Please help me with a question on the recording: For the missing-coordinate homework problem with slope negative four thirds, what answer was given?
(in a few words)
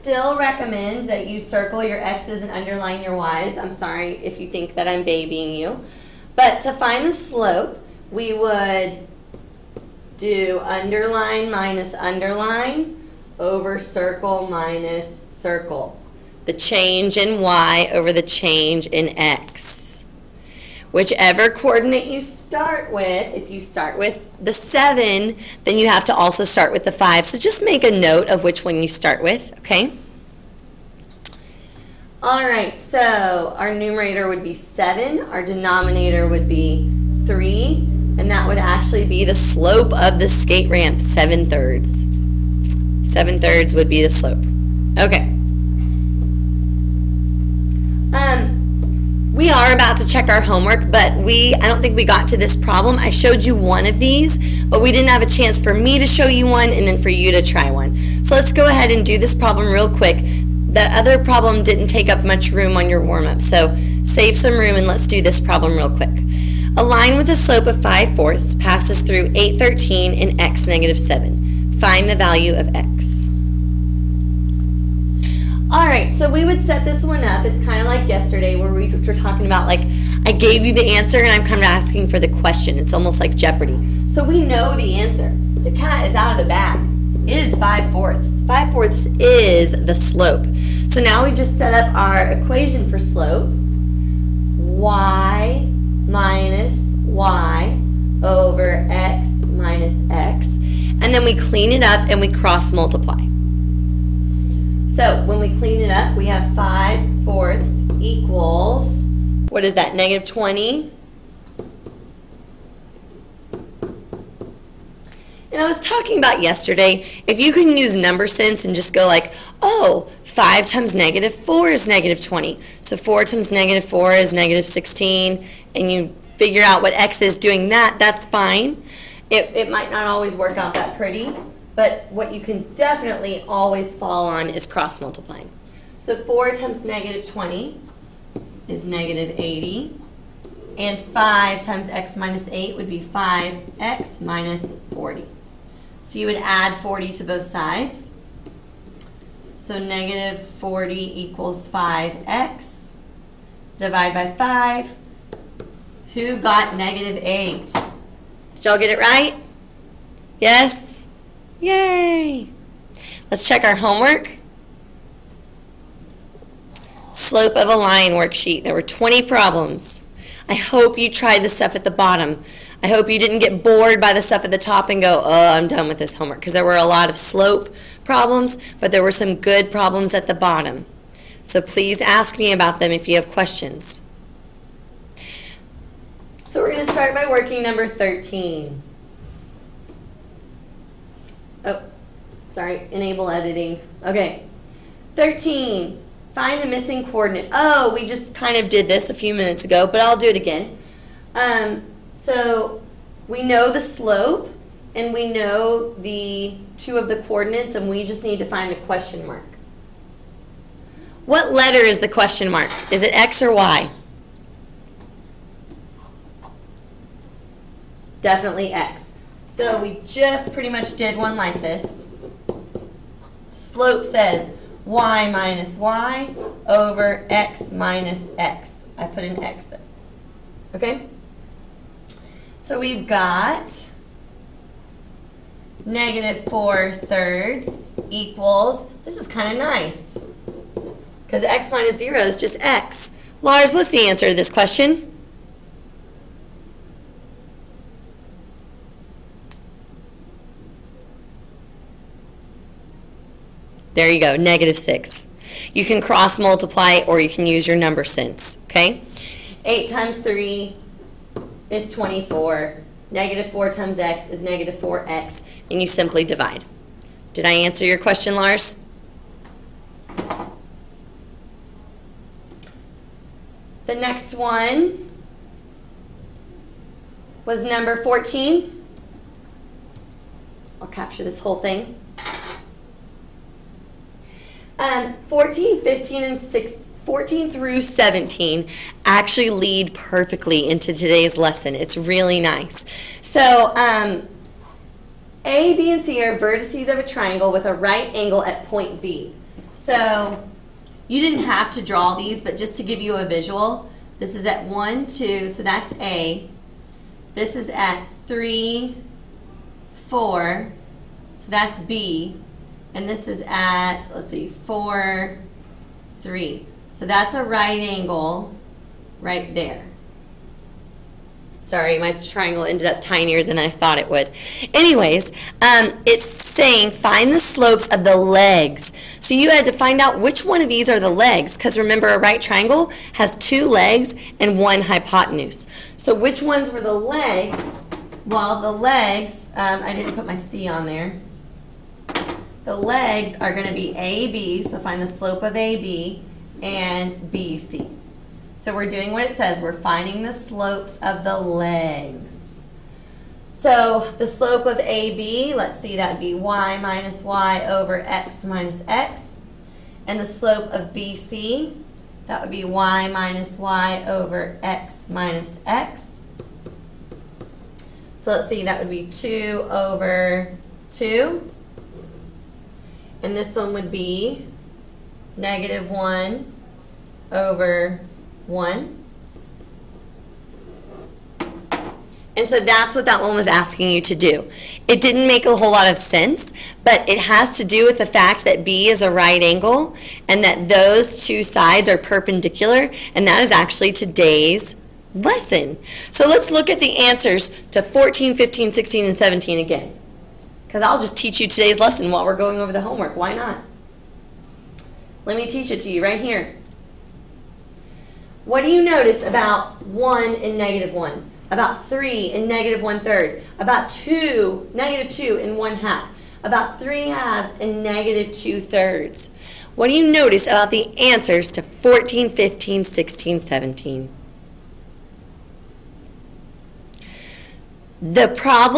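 -6.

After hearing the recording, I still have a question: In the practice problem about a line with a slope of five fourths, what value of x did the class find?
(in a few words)
-8.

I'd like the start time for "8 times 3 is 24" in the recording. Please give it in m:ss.
4:19.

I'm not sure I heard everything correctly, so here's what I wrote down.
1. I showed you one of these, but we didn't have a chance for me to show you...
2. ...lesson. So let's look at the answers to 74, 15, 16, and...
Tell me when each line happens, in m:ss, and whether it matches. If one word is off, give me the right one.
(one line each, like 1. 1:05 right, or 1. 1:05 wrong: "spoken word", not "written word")
1. 0:52 right
2. 6:35 wrong: "14", not "74".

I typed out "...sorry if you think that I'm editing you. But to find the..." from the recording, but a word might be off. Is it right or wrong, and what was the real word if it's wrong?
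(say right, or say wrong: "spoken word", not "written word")
wrong: "babying", not "editing".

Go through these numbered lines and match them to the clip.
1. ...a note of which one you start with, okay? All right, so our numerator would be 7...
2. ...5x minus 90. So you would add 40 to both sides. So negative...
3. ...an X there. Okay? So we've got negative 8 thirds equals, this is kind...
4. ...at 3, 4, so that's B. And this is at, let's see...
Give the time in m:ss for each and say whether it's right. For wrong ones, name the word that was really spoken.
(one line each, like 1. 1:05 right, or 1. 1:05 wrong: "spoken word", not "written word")
1. 0:27 right
2. 2:22 wrong: "40", not "90"
3. 3:49 wrong: "4", not "8"
4. 5:07 right.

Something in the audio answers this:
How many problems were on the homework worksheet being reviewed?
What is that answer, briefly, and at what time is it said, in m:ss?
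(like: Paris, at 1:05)
20, at 2:48.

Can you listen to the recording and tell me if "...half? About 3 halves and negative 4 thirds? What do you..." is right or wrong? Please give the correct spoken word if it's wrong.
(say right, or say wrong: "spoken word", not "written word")
wrong: "2", not "4".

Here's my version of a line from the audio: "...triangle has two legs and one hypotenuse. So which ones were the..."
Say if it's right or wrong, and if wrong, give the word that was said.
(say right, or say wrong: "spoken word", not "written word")
right.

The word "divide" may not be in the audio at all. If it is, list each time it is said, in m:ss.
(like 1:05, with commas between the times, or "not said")
2:33, 4:26.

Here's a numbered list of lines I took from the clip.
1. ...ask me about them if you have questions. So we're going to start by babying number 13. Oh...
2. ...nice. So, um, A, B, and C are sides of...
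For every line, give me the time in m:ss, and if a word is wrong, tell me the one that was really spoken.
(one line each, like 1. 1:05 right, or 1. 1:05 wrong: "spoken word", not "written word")
1. 3:01 wrong: "working", not "babying"
2. 4:52 wrong: "vertices", not "sides".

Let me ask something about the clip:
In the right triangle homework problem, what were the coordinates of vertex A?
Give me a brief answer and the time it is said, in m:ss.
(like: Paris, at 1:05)
(1, 2), at 5:04.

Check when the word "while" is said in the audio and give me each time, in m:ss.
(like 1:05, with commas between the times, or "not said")
6:42.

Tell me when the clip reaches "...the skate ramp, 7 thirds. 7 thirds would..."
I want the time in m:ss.
0:40.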